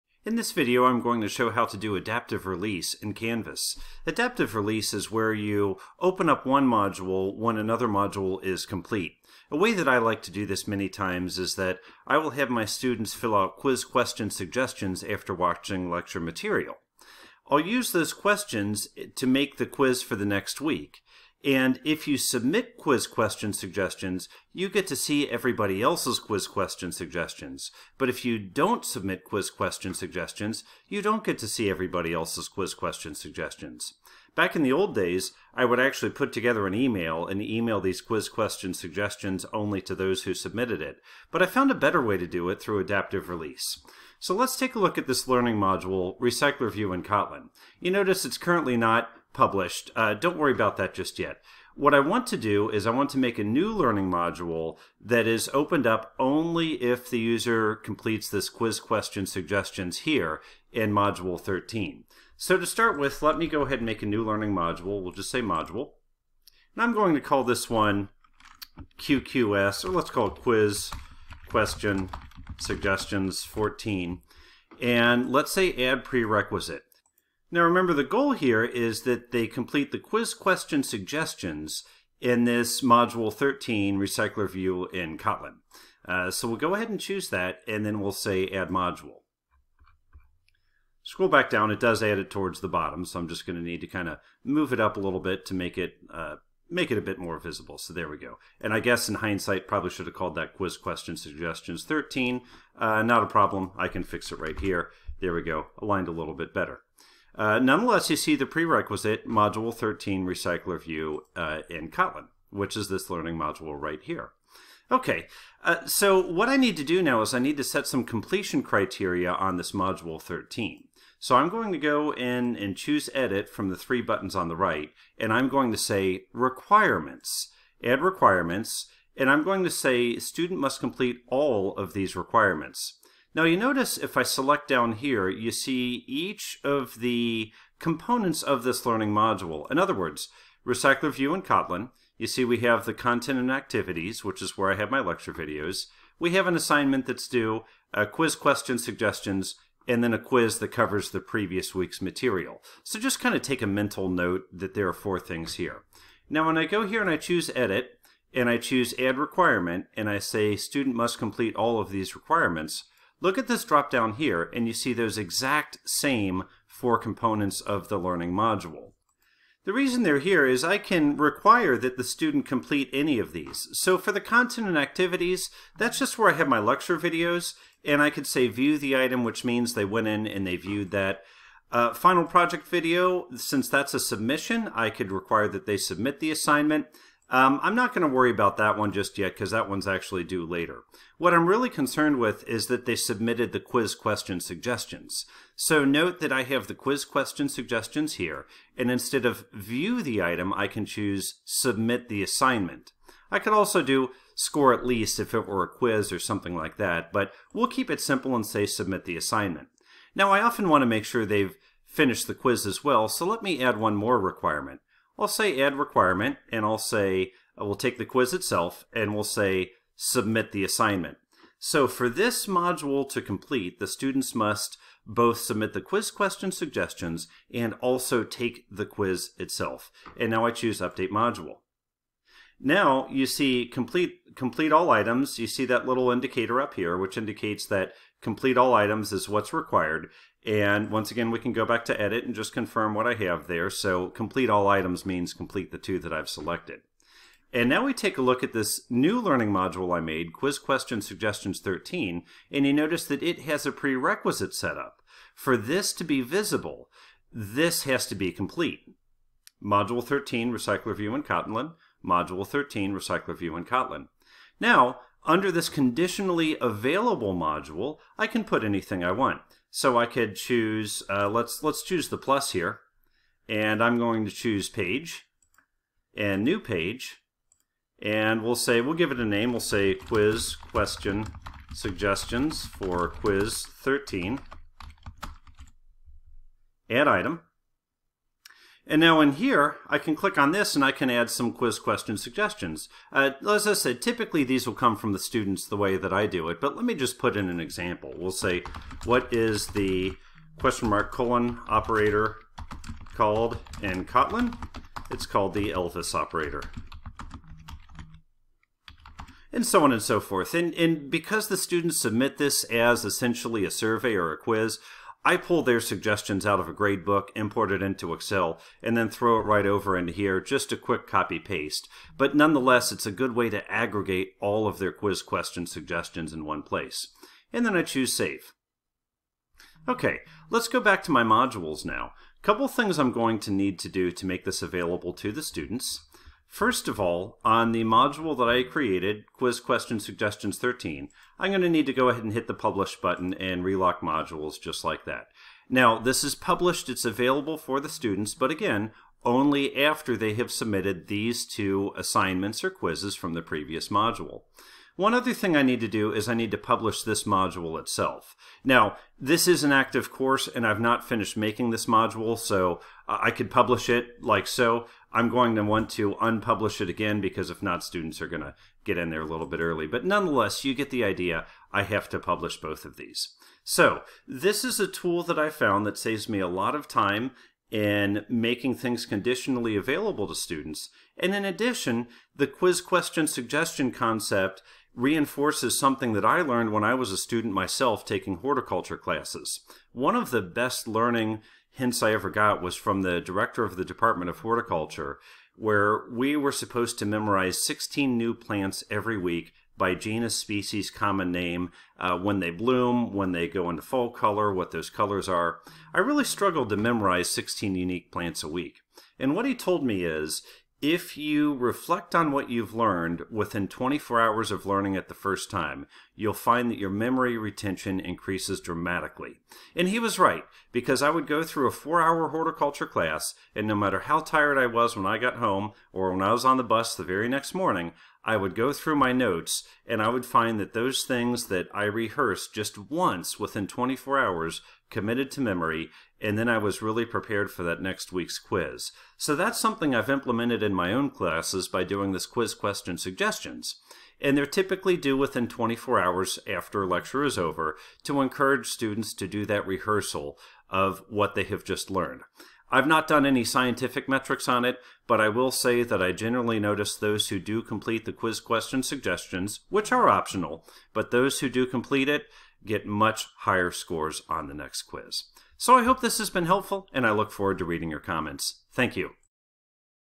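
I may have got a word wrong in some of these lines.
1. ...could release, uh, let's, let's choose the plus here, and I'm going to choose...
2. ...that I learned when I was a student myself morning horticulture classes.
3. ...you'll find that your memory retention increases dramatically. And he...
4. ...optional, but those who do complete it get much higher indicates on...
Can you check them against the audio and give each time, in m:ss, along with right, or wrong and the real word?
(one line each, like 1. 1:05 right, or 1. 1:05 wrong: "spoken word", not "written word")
1. 4:30 wrong: "choose", not "release"
2. 6:26 wrong: "taking", not "morning"
3. 6:56 right
4. 7:40 wrong: "scores", not "indicates".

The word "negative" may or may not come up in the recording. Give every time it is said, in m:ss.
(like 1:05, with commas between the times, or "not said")
not said.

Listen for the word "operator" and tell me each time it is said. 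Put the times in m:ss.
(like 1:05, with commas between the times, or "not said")
5:01, 5:06.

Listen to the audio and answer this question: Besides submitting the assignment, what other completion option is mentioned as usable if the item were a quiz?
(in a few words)
score at least.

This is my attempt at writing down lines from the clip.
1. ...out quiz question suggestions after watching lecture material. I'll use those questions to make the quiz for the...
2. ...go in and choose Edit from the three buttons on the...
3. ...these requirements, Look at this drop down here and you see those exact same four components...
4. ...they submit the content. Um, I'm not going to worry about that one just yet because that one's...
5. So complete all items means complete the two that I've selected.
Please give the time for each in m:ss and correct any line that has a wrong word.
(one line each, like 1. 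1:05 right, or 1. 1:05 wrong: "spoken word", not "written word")
1. 0:13 right
2. 2:01 right
3. 2:41 right
4. 3:05 wrong: "assignment", not "content"
5. 4:03 right.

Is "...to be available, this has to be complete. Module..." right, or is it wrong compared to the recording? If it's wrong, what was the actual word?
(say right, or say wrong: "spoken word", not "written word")
wrong: "visible", not "available".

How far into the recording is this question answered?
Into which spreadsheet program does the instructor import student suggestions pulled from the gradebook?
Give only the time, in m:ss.
5:18.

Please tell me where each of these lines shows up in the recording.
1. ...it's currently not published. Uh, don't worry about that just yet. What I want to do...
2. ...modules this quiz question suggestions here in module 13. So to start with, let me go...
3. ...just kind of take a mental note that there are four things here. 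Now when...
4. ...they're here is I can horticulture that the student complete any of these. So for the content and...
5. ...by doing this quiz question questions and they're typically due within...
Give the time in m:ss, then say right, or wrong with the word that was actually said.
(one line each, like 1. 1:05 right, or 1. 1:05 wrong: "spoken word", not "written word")
1. 0:48 right
2. 0:57 wrong: "completes", not "modules"
3. 2:32 right
4. 2:50 wrong: "require", not "horticulture"
5. 7:21 wrong: "suggestions", not "questions".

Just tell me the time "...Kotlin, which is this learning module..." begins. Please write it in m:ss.
1:51.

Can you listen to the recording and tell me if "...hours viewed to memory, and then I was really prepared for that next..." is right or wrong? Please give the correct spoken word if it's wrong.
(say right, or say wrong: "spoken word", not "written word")
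wrong: "committed", not "viewed".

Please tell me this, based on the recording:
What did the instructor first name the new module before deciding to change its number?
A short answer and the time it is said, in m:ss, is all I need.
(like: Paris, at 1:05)
quiz question suggestions 14, at 1:10.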